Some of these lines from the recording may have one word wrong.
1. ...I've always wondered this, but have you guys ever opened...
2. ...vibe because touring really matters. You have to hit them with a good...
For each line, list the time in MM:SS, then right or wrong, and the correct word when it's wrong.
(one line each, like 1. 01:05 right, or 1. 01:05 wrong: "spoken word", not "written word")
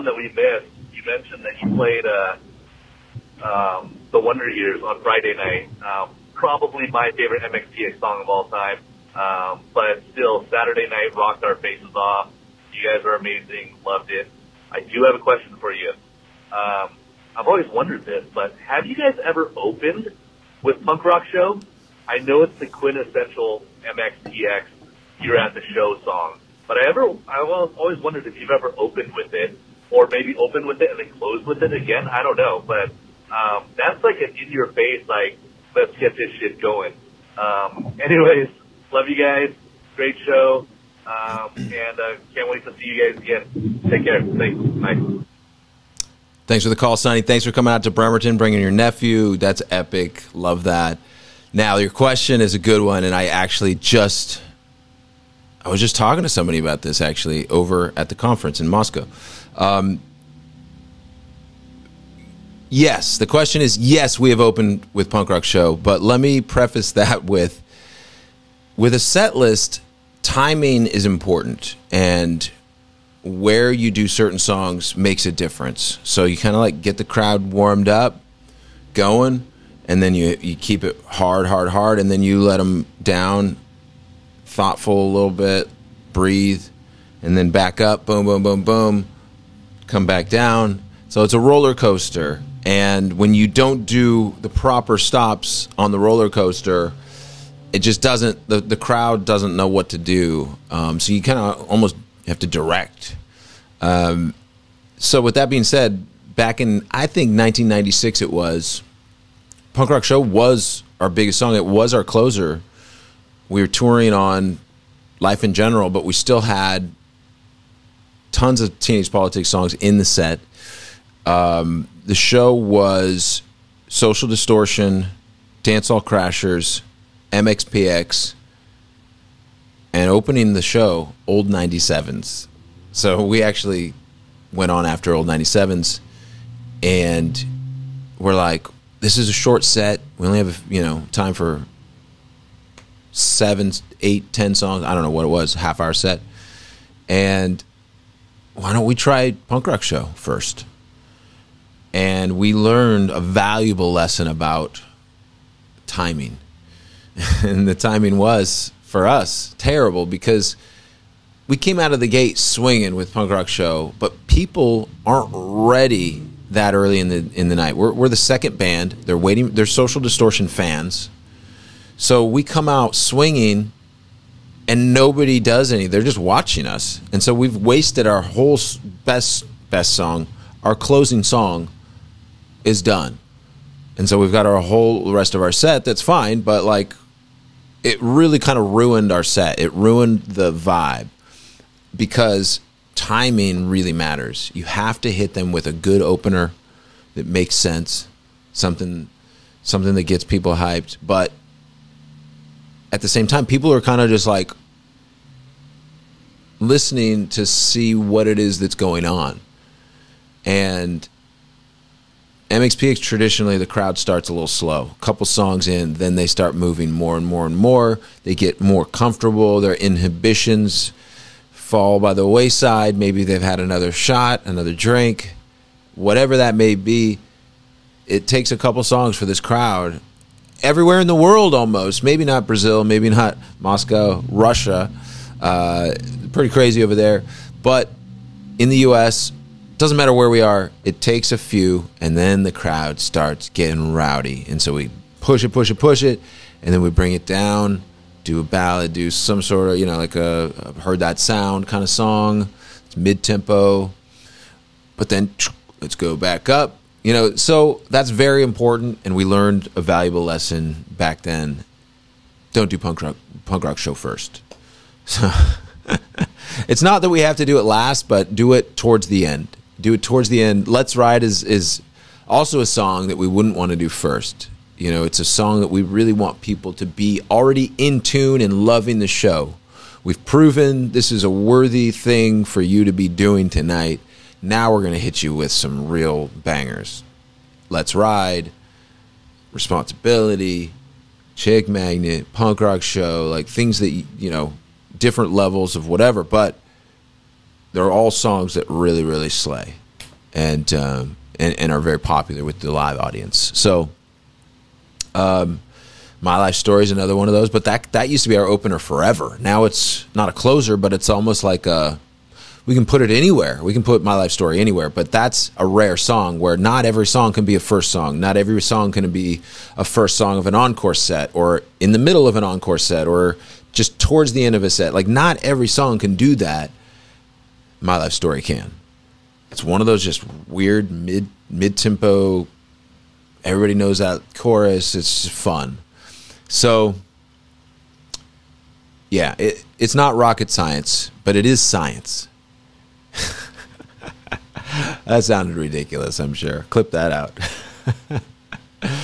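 1. 00:17 right
2. 03:10 wrong: "timing", not "touring".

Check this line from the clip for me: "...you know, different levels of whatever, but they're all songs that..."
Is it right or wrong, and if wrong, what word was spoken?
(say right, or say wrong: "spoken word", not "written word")
right.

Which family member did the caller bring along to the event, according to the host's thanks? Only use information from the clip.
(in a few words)
Nephew.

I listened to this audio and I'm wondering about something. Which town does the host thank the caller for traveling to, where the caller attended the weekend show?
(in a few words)
Bremerton.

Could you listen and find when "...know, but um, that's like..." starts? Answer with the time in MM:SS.
00:32.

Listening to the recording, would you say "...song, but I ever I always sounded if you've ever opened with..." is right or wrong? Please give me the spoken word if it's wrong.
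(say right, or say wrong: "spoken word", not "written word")
wrong: "wondered", not "sounded".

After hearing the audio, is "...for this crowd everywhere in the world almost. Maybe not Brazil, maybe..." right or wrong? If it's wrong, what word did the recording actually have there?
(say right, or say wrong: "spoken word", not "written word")
right.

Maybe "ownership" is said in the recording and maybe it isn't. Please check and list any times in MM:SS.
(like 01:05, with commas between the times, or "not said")
not said.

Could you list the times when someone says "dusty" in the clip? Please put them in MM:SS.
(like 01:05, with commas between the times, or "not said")
not said.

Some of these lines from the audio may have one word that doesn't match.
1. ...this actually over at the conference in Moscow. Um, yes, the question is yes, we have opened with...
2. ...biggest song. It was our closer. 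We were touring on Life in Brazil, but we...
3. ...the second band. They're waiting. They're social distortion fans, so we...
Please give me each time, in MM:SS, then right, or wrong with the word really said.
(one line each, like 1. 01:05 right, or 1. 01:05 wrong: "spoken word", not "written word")
1. 00:56 right
2. 01:51 wrong: "General", not "Brazil"
3. 02:48 right.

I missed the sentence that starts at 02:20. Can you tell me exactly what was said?
We only have, you know, time for seven, eight, ten songs.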